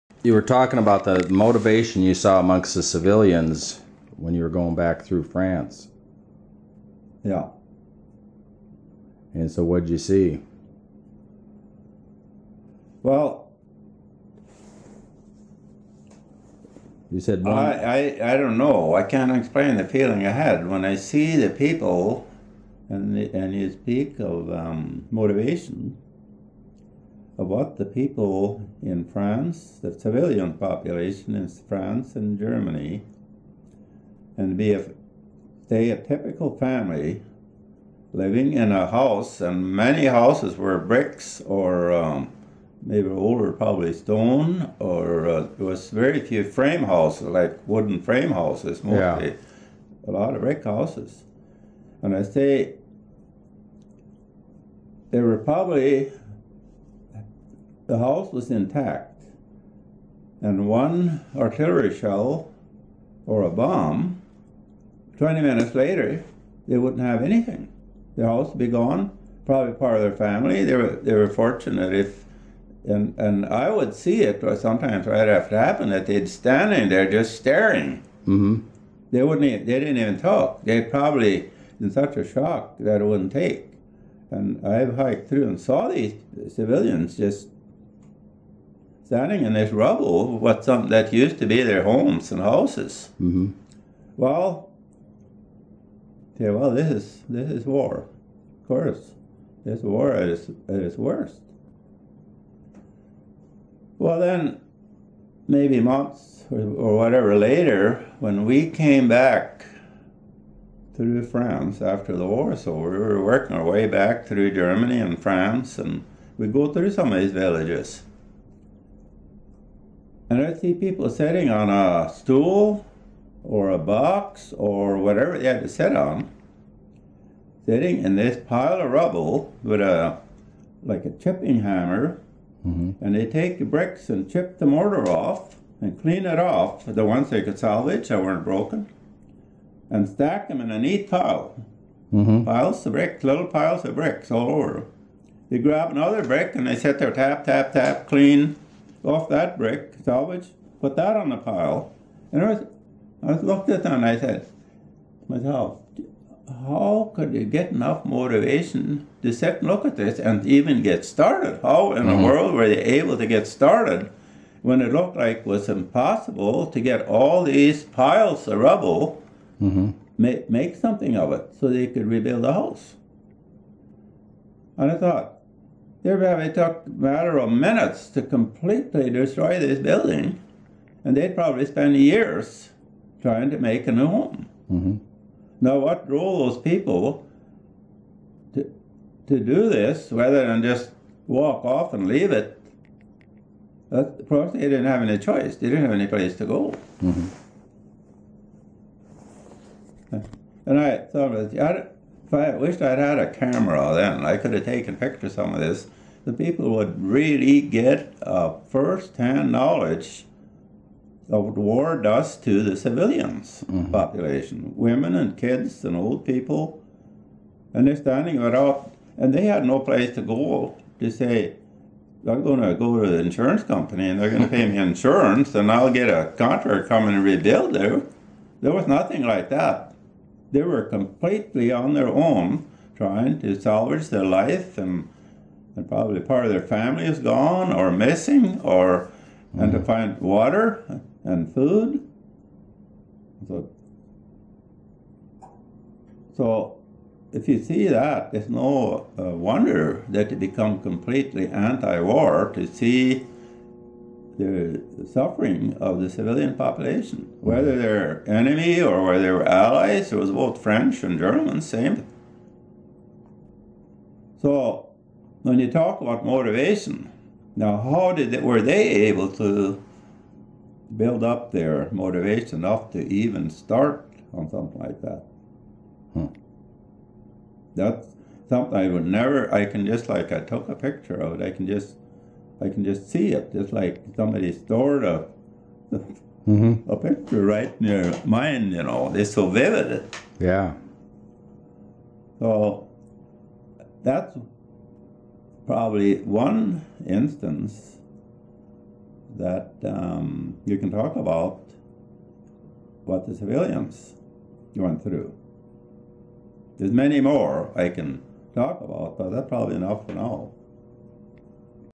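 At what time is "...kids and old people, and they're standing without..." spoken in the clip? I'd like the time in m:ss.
3:35.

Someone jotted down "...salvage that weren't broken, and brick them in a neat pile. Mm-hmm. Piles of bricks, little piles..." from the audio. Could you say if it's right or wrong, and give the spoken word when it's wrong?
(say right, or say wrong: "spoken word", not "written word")
wrong: "stack", not "brick".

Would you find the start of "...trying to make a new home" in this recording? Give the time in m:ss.
3:03.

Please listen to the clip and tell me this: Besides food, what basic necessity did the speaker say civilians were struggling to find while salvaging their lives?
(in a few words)
water.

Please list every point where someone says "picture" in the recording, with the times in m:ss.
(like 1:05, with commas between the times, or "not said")
3:24, 4:40, 4:46.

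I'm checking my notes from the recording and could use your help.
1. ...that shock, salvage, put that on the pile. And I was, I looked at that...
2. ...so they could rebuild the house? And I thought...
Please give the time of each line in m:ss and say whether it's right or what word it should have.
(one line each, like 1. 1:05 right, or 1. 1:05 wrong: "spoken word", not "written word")
1. 2:29 wrong: "brick", not "shock"
2. 2:51 right.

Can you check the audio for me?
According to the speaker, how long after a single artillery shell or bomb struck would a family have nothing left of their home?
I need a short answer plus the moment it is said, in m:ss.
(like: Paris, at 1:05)
20 minutes, at 1:05.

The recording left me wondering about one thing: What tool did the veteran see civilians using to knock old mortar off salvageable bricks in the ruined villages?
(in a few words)
chipping hammer.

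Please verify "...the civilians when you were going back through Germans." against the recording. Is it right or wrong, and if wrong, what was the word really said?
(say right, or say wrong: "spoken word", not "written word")
wrong: "France", not "Germans".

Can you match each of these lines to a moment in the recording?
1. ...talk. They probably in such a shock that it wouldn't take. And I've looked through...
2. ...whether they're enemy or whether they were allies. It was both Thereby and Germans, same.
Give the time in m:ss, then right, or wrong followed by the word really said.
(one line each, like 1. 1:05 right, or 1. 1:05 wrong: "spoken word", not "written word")
1. 1:20 wrong: "hiked", not "looked"
2. 4:17 wrong: "French", not "Thereby".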